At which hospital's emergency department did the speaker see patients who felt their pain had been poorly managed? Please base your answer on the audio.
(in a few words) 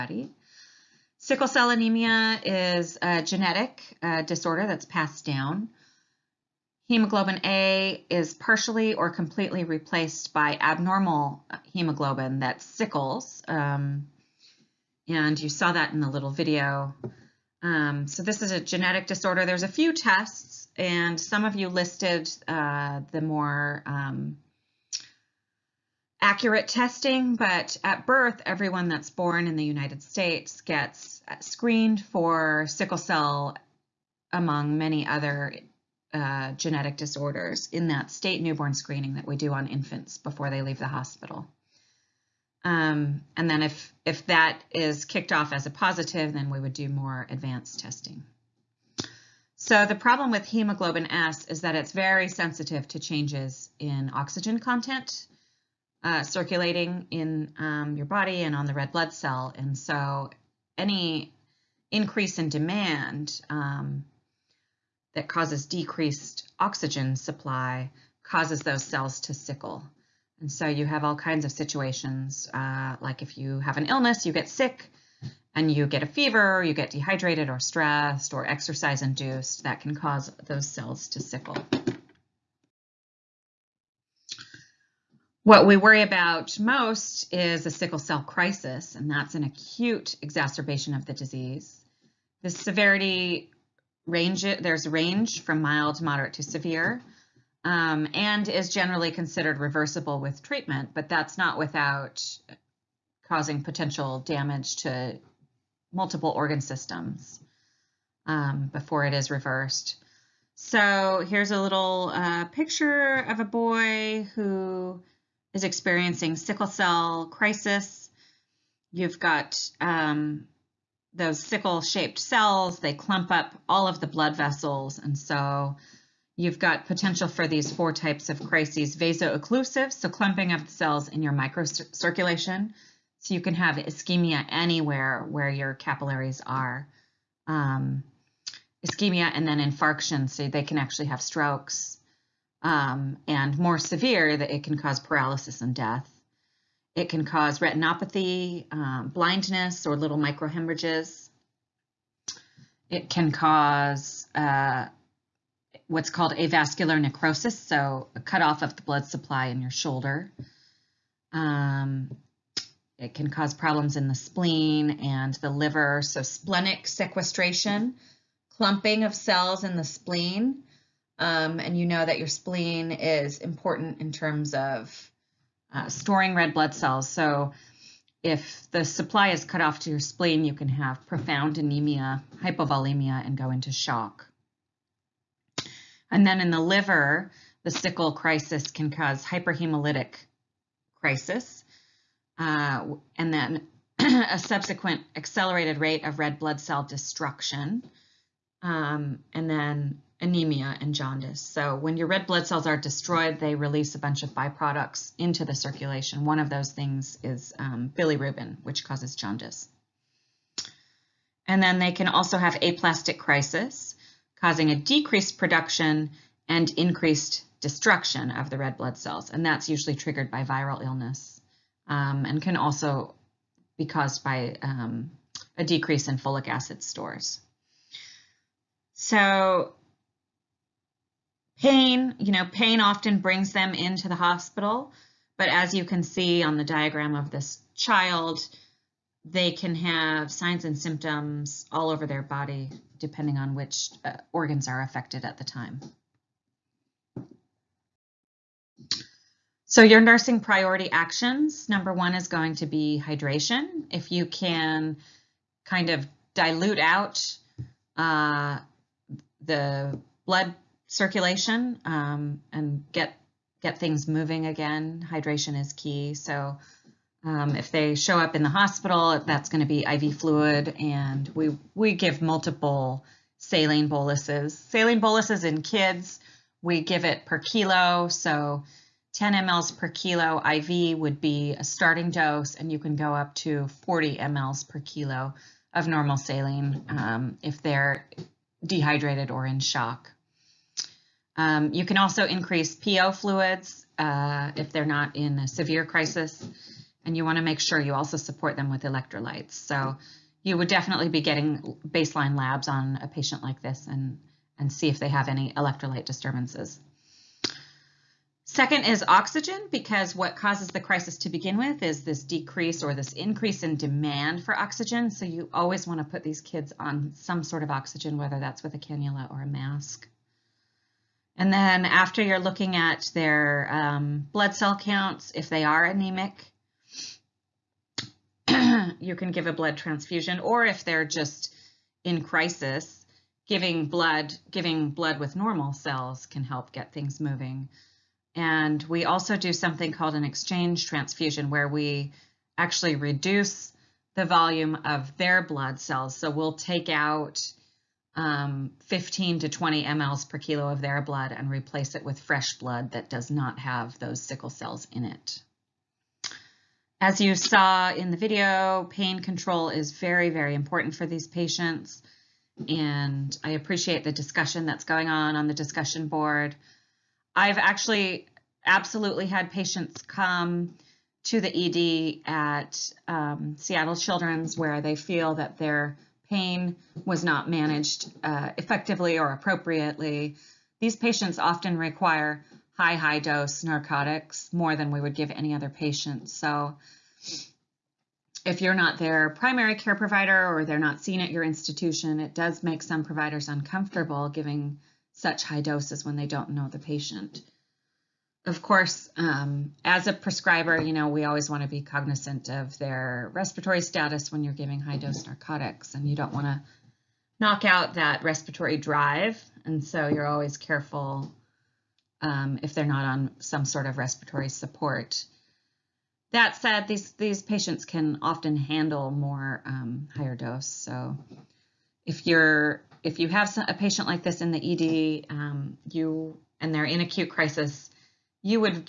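Seattle Children's.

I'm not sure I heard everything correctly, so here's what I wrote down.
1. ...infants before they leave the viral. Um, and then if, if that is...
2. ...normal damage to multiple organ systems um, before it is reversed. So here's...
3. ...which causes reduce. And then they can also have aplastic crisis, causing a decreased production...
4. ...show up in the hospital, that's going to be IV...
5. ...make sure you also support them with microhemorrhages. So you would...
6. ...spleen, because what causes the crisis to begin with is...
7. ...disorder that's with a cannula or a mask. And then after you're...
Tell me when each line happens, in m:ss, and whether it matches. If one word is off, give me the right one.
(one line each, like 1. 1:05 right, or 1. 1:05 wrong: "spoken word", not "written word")
1. 0:39 wrong: "hospital", not "viral"
2. 1:43 wrong: "potential", not "normal"
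3. 3:28 wrong: "jaundice", not "reduce"
4. 4:27 right
5. 4:57 wrong: "electrolytes", not "microhemorrhages"
6. 5:09 wrong: "oxygen", not "spleen"
7. 5:18 wrong: "whether", not "disorder".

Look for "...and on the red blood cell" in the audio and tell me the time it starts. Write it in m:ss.
0:58.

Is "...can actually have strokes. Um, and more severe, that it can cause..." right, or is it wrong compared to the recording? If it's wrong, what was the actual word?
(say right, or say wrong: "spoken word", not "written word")
right.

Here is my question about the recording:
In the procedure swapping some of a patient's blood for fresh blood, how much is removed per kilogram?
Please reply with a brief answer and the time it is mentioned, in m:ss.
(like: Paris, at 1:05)
15 to 20 mL, at 5:48.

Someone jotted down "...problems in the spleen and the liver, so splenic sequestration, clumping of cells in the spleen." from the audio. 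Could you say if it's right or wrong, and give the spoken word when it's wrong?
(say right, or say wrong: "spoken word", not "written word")
right.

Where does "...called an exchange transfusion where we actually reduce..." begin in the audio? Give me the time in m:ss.
5:39.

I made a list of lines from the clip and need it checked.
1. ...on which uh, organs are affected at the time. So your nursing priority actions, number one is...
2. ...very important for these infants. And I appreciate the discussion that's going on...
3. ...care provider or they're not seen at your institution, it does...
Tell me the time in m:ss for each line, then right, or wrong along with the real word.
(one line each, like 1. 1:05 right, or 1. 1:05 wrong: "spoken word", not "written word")
1. 4:03 right
2. 6:00 wrong: "patients", not "infants"
3. 6:29 right.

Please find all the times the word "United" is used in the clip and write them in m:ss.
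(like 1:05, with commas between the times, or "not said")
0:29.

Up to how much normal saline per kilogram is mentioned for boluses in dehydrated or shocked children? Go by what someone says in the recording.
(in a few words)
40 mL per kilo.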